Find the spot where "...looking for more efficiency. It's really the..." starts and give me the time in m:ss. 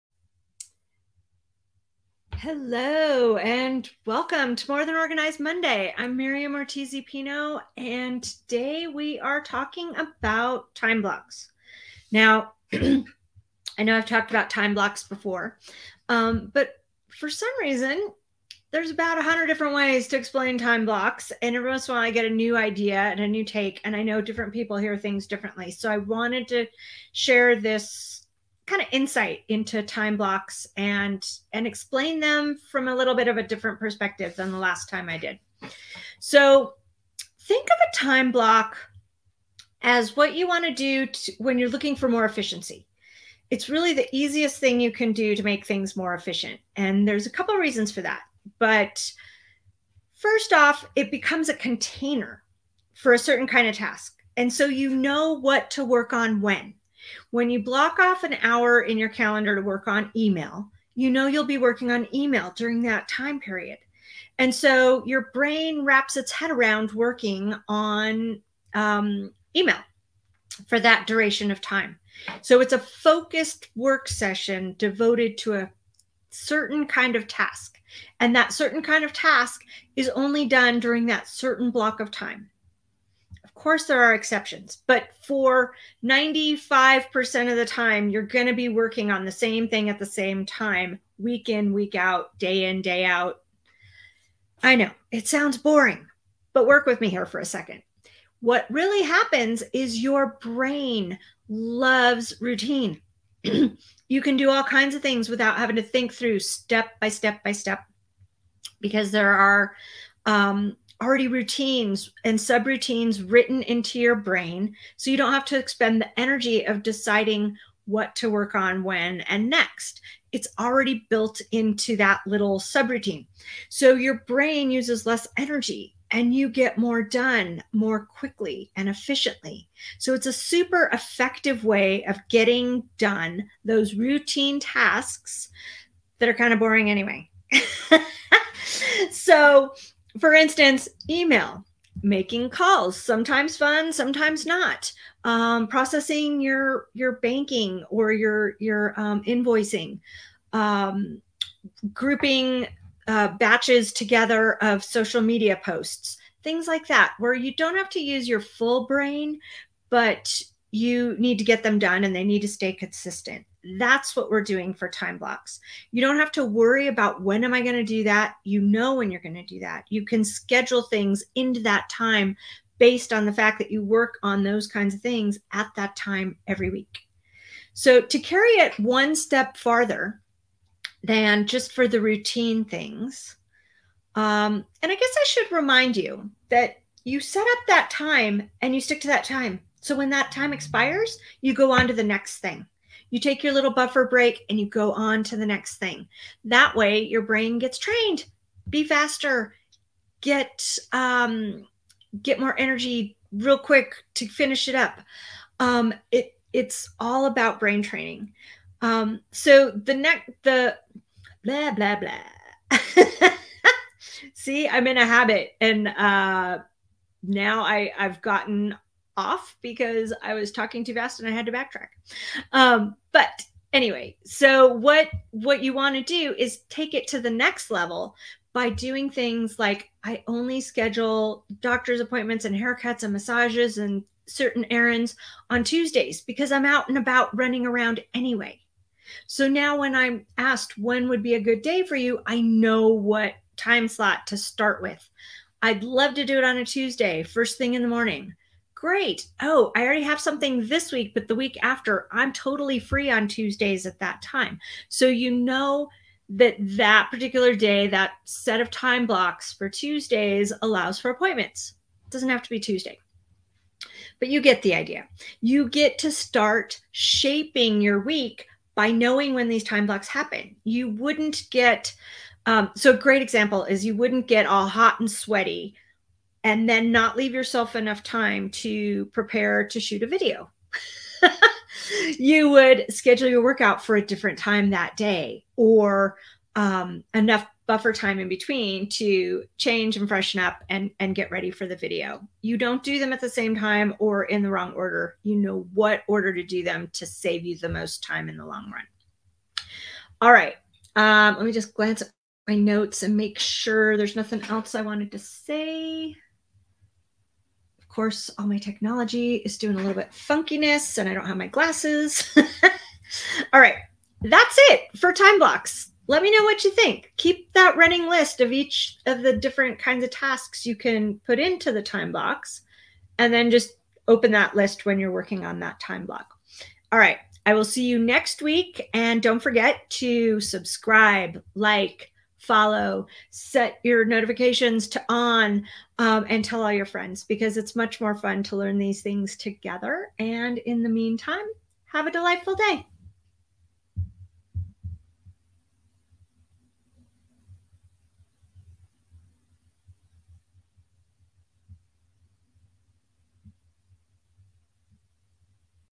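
0:41.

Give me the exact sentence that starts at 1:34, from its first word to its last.
I know it sounds boring, but work with me here for a second.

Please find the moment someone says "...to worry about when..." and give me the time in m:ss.
2:46.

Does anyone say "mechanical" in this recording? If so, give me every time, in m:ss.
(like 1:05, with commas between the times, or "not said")
not said.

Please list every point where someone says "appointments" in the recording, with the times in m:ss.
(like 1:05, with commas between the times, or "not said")
3:52, 4:21.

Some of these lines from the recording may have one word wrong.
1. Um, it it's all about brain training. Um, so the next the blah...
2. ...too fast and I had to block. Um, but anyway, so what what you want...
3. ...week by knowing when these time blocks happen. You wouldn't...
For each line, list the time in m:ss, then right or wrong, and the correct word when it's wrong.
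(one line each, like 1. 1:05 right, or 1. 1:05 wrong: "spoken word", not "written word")
1. 3:25 right
2. 3:40 wrong: "backtrack", not "block"
3. 4:28 right.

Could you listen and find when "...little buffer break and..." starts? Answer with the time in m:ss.
3:13.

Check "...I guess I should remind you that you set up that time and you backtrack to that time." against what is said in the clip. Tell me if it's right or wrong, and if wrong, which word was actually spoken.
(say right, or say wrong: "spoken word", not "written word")
wrong: "stick", not "backtrack".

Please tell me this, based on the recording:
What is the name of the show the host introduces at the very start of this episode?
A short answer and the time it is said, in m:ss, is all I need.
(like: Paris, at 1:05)
More Than Organized Monday, at 0:04.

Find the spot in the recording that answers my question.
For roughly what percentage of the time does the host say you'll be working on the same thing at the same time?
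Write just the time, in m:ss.
1:26.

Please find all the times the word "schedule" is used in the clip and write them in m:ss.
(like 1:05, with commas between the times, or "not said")
2:50, 3:50, 4:42.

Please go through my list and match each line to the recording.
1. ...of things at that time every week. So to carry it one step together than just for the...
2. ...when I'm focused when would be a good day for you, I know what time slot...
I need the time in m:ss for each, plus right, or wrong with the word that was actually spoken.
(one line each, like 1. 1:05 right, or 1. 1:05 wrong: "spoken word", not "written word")
1. 2:54 wrong: "farther", not "together"
2. 3:59 wrong: "asked", not "focused".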